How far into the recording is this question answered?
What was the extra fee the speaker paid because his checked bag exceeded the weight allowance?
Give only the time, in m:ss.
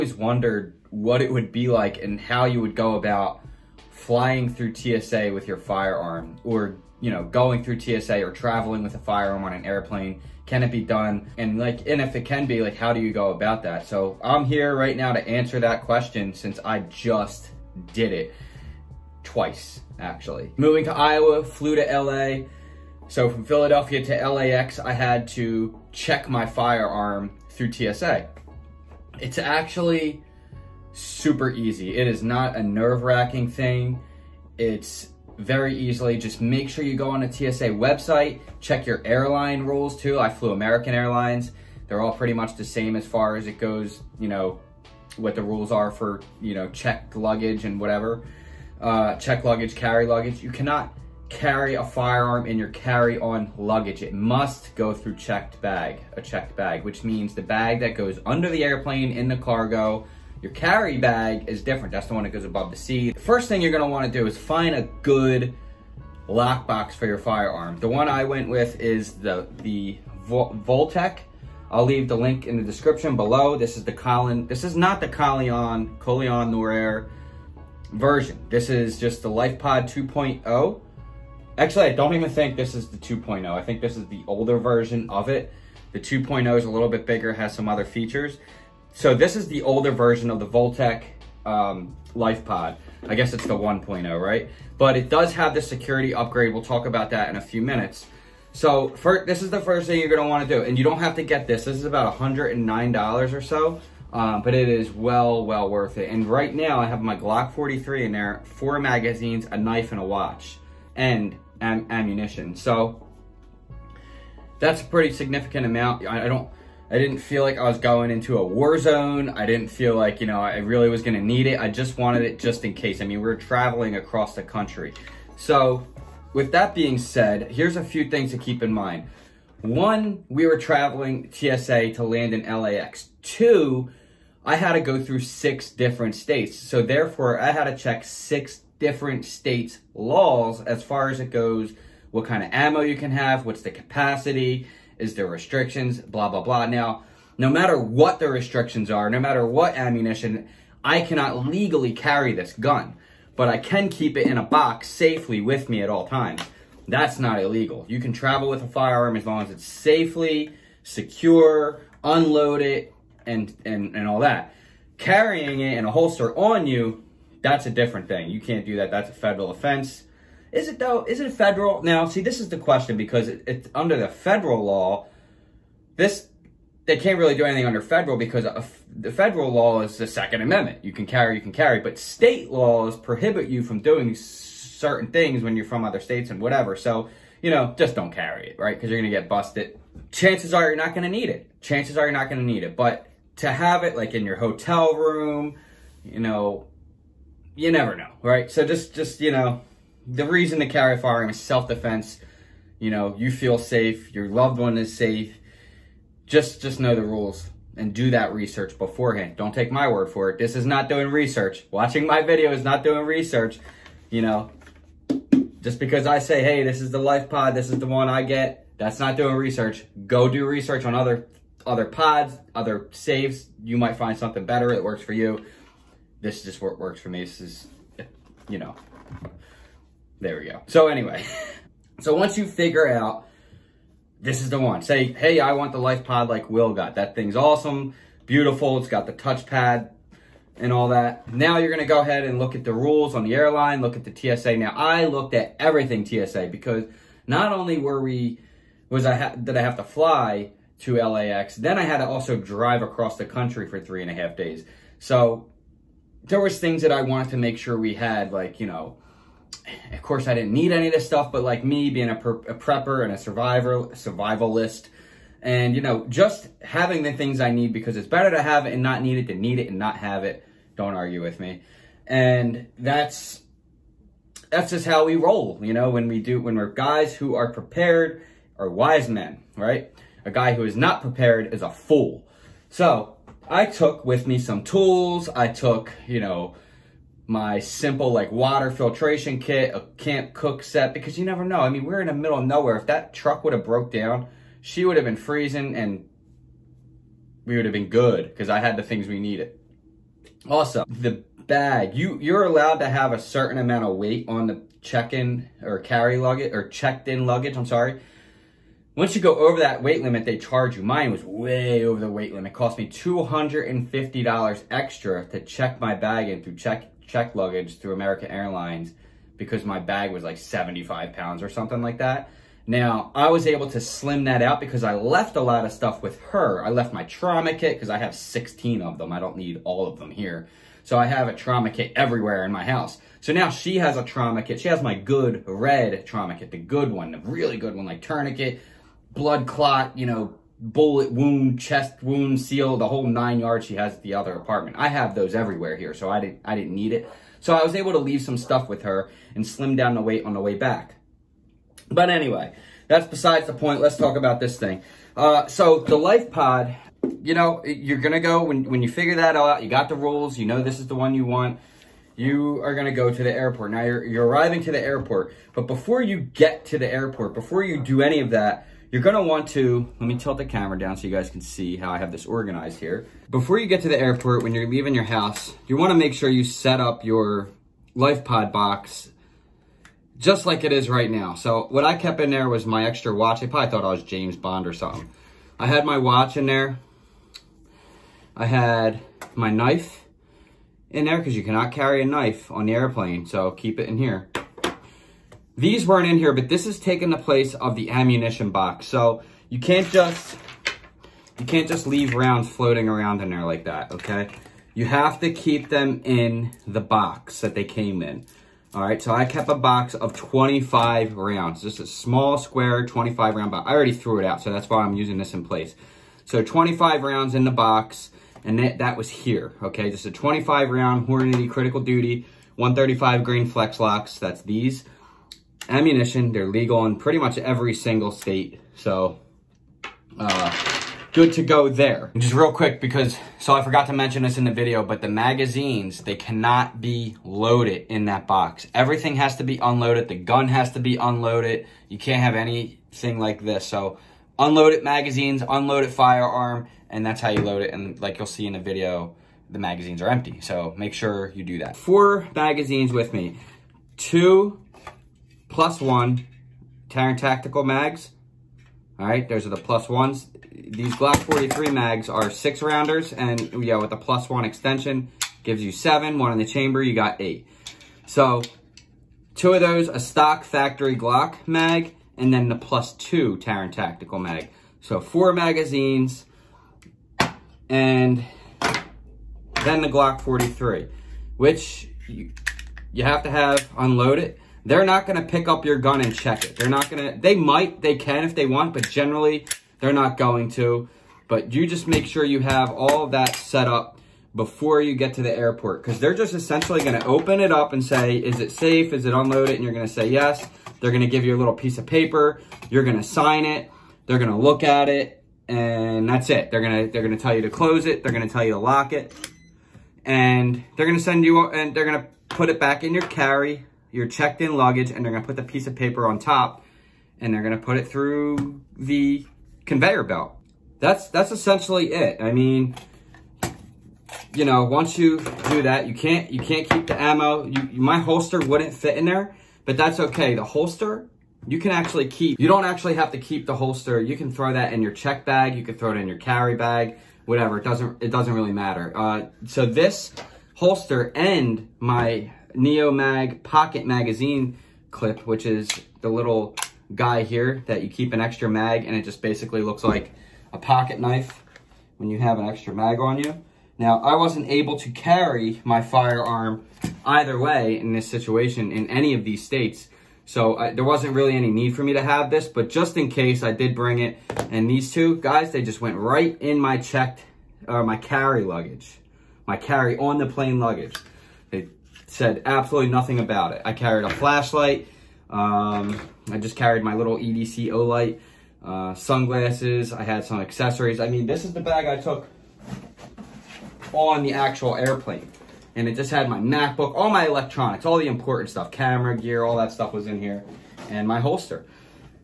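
5:12.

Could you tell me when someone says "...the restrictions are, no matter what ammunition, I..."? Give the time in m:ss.
2:28.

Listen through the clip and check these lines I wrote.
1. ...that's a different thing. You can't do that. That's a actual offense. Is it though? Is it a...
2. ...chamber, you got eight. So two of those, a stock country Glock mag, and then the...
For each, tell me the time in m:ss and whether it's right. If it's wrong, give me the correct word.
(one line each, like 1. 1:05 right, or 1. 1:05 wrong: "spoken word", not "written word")
1. 2:47 wrong: "federal", not "actual"
2. 7:46 wrong: "factory", not "country".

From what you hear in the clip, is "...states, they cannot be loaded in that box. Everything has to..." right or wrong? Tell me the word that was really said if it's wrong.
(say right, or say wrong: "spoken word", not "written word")
wrong: "magazines", not "states".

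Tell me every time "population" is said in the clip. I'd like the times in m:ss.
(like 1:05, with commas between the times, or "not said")
not said.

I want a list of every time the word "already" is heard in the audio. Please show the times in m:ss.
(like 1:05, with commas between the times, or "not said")
6:53.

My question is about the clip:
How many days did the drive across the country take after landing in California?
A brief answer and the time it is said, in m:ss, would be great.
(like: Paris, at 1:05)
3.5, at 4:13.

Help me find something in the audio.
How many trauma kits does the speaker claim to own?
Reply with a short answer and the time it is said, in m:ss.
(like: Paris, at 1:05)
16, at 5:28.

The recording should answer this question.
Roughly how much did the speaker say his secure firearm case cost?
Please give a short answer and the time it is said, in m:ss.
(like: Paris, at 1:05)
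$109, at 1:42.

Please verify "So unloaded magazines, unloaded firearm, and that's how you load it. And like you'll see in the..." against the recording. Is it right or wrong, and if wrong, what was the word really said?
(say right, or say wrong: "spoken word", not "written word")
right.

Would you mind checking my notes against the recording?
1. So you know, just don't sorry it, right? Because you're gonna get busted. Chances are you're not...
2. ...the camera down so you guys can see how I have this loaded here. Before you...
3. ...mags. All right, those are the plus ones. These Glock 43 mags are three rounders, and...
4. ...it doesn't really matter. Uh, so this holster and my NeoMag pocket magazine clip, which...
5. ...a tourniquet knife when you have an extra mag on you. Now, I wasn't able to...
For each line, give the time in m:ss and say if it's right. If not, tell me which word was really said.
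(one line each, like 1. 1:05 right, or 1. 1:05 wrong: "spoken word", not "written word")
1. 3:06 wrong: "carry", not "sorry"
2. 6:10 wrong: "organized", not "loaded"
3. 7:37 wrong: "six", not "three"
4. 8:58 right
5. 9:10 wrong: "pocket", not "tourniquet".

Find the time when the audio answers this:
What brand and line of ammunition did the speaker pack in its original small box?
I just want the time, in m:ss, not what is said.
7:01.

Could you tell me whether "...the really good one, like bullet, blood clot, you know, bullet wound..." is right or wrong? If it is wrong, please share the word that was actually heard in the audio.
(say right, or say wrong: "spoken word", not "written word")
wrong: "tourniquet", not "bullet".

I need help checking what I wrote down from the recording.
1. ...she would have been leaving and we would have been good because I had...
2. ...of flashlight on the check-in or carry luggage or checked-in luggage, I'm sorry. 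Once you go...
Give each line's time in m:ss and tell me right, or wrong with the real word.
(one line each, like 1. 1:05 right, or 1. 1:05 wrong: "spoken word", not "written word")
1. 4:54 wrong: "freezing", not "leaving"
2. 5:03 wrong: "weight", not "flashlight".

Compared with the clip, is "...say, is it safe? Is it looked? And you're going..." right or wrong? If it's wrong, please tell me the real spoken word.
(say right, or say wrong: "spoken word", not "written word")
wrong: "unloaded", not "looked".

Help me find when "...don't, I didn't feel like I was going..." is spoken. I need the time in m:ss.
1:56.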